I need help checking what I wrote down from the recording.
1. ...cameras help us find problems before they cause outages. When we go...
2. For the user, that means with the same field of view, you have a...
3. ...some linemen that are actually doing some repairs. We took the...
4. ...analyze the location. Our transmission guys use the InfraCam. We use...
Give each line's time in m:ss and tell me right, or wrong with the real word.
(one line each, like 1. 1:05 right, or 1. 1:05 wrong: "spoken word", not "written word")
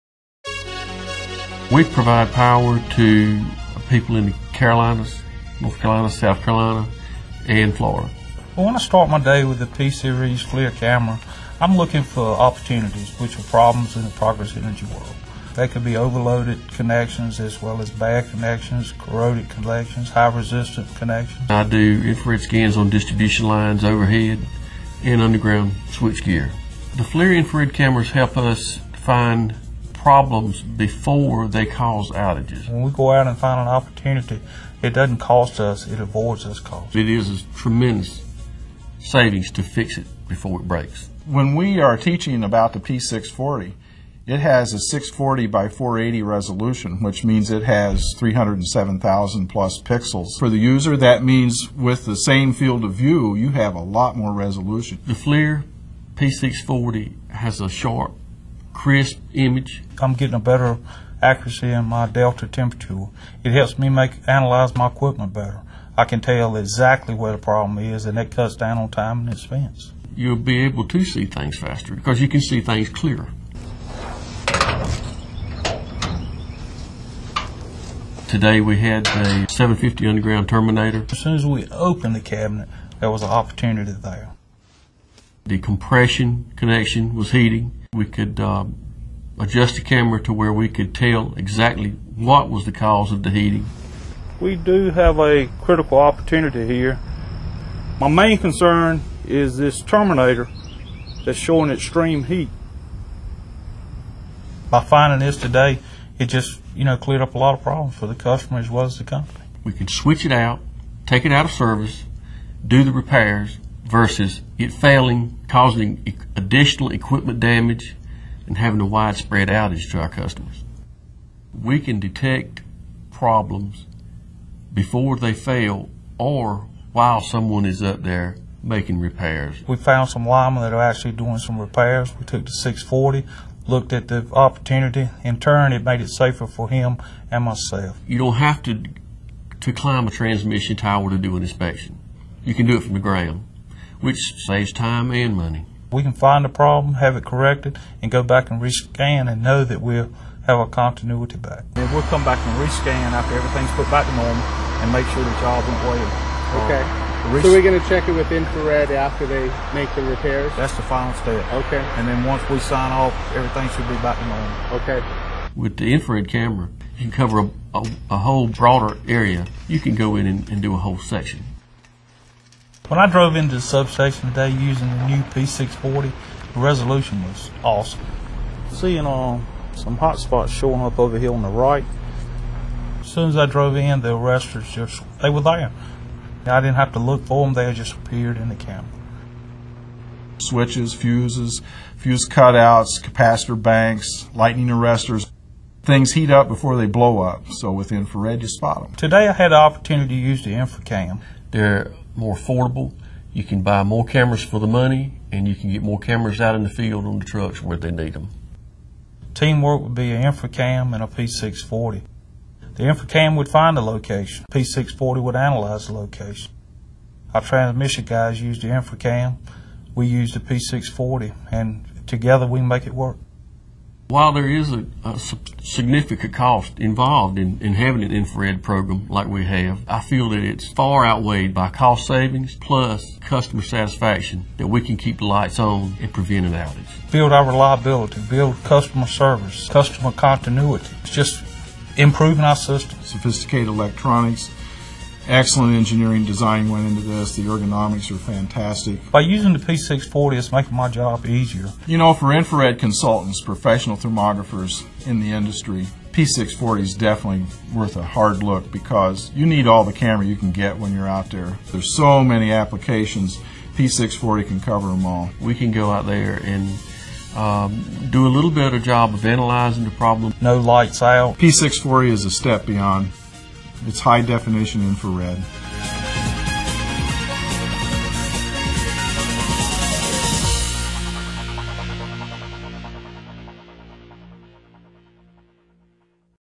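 1. 0:27 right
2. 0:50 right
3. 2:10 right
4. 3:35 right.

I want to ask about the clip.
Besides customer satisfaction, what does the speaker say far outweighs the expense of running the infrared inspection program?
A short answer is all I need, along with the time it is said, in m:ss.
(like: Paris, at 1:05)
cost savings, at 3:51.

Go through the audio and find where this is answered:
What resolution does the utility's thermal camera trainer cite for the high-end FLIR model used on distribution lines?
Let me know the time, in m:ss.
0:44.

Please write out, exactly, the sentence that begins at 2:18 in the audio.
You don't have to to climb a transmission tower to do an inspection.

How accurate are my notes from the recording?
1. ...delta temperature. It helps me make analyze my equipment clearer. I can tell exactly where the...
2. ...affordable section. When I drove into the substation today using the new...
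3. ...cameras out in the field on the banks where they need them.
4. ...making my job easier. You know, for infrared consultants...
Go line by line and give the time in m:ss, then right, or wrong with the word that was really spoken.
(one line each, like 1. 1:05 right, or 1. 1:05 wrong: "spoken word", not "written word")
1. 1:02 wrong: "better", not "clearer"
2. 2:50 wrong: "whole", not "affordable"
3. 3:25 wrong: "trucks", not "banks"
4. 4:10 right.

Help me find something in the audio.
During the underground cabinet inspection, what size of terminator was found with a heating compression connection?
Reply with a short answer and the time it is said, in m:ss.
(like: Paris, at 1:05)
750, at 1:19.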